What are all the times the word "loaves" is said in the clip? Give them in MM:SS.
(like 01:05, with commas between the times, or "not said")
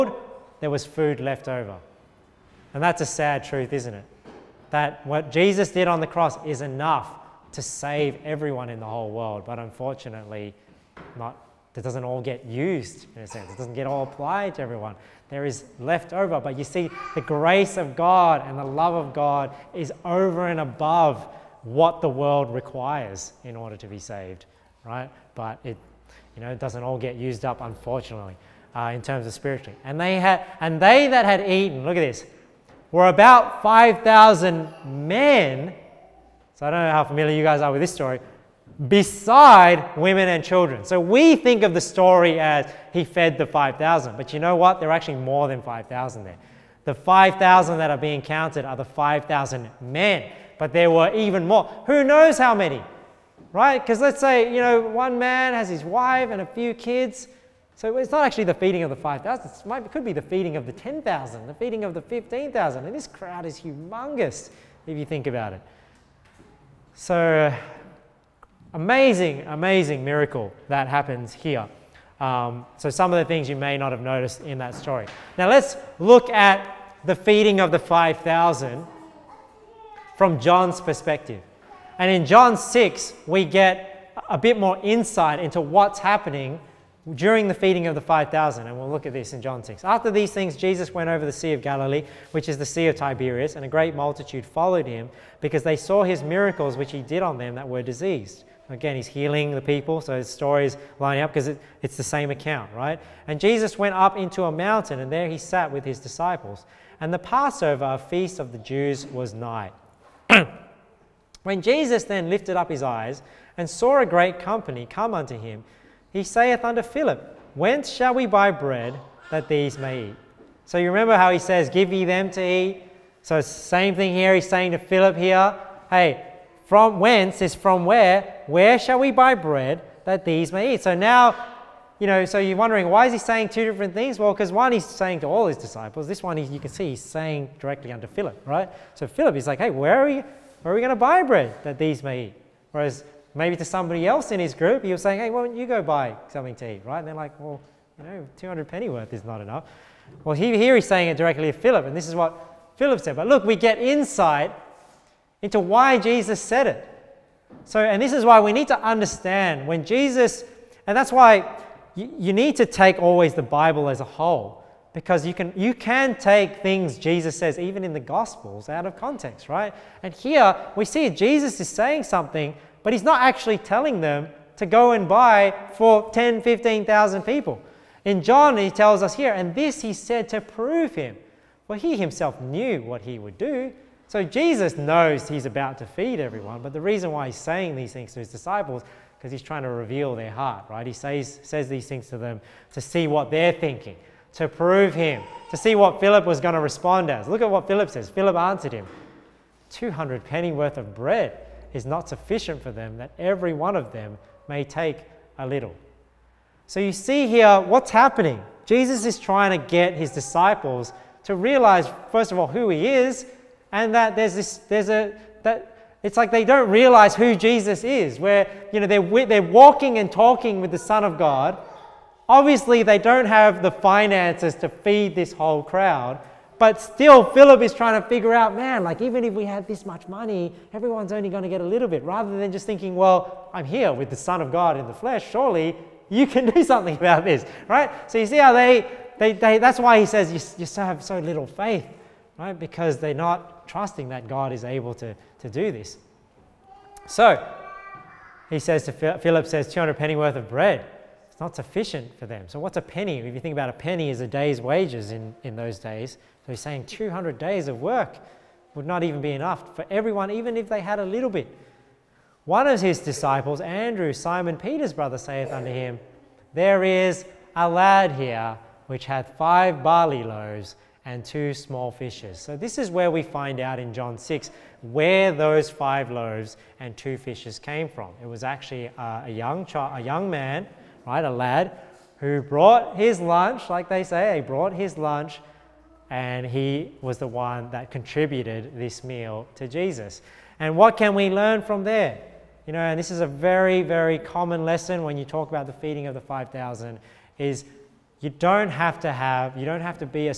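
04:30, 04:36.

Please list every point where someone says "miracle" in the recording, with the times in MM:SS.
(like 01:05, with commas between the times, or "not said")
01:10, 01:36.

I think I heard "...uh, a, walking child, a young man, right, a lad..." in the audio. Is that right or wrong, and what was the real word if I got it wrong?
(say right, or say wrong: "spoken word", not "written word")
wrong: "young", not "walking".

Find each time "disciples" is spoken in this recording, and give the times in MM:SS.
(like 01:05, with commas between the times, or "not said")
01:45, 02:15, 03:08, 03:30, 04:22.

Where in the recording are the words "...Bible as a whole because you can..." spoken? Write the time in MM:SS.
02:43.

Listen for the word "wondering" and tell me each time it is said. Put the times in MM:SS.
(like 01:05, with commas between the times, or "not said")
02:12.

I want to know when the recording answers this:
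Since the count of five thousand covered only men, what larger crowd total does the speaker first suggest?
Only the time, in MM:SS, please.
01:00.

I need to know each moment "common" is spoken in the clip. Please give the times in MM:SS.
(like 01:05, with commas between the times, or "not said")
04:54.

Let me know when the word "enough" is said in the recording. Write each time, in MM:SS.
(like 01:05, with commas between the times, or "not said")
00:06, 02:29, 04:19.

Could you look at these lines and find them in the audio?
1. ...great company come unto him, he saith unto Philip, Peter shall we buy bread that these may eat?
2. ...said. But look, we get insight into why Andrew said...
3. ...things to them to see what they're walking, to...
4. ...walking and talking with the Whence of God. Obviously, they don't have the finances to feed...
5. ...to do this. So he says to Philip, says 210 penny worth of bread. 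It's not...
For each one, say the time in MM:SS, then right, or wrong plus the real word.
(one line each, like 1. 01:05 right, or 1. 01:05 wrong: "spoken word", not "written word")
1. 01:54 wrong: "Whence", not "Peter"
2. 02:33 wrong: "Jesus", not "Andrew"
3. 03:11 wrong: "thinking", not "walking"
4. 03:39 wrong: "Son", not "Whence"
5. 04:05 wrong: "200", not "210".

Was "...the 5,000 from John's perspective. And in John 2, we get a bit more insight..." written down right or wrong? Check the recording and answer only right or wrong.
wrong.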